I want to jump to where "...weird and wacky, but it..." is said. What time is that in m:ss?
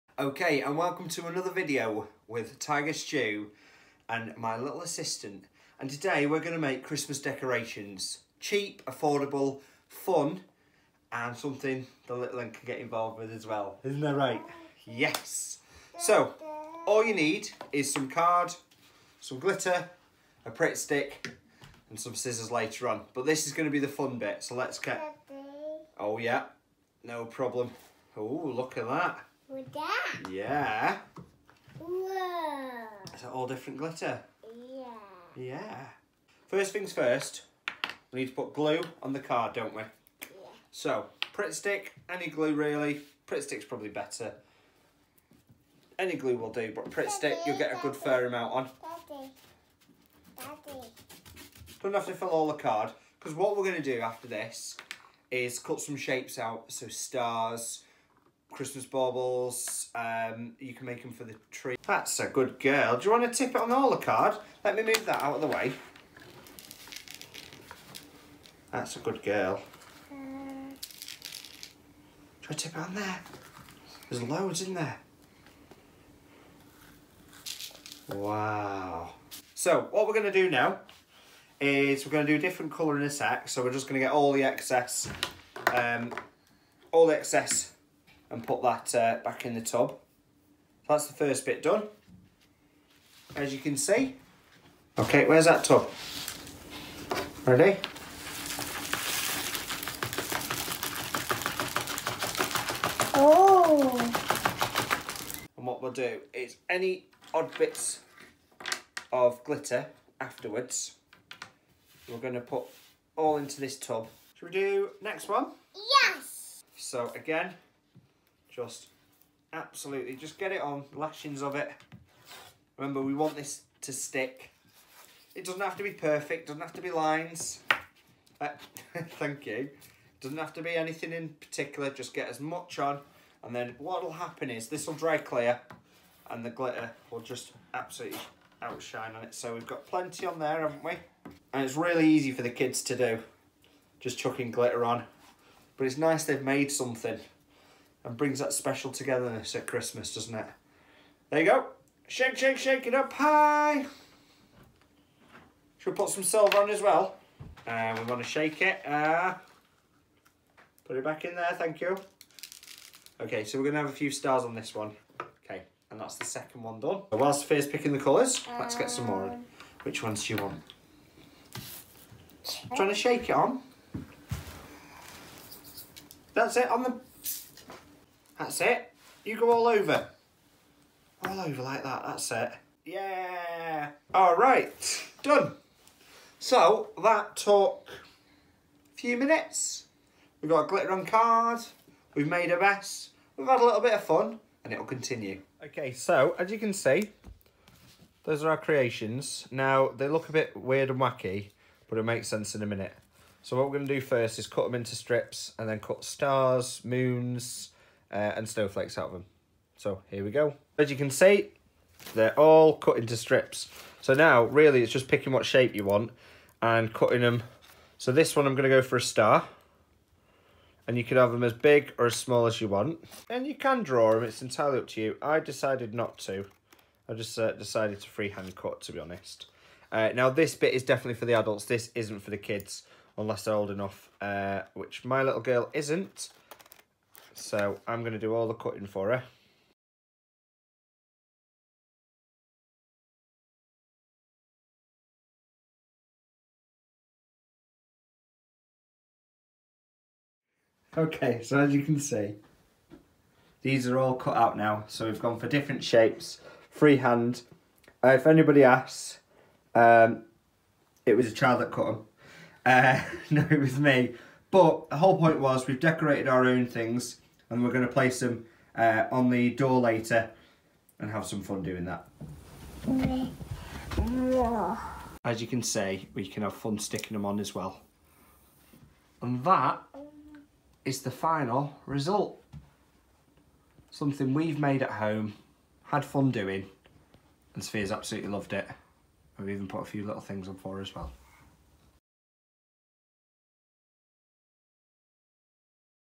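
3:20.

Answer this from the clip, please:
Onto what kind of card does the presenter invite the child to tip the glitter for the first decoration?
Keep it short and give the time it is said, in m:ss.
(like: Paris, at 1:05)
holo card, at 1:03.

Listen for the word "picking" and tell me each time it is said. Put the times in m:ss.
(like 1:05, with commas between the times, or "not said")
2:47, 3:35.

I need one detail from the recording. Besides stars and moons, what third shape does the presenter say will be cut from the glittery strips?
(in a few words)
snowflakes.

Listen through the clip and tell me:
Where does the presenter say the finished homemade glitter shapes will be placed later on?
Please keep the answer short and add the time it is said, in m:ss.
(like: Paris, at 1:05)
on the door, at 4:29.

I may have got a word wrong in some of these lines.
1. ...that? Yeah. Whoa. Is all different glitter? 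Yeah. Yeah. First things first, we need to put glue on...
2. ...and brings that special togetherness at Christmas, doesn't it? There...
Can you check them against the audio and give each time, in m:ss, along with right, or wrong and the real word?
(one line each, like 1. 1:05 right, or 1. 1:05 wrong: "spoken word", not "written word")
1. 0:29 right
2. 2:28 right.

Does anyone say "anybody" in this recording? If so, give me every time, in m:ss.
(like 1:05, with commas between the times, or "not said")
4:18.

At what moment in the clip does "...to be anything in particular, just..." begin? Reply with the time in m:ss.
2:10.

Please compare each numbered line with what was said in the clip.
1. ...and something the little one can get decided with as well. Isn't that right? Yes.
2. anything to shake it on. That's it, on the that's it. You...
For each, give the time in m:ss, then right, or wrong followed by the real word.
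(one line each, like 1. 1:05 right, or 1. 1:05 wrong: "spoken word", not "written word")
1. 0:11 wrong: "involved", not "decided"
2. 2:52 wrong: "trying", not "anything".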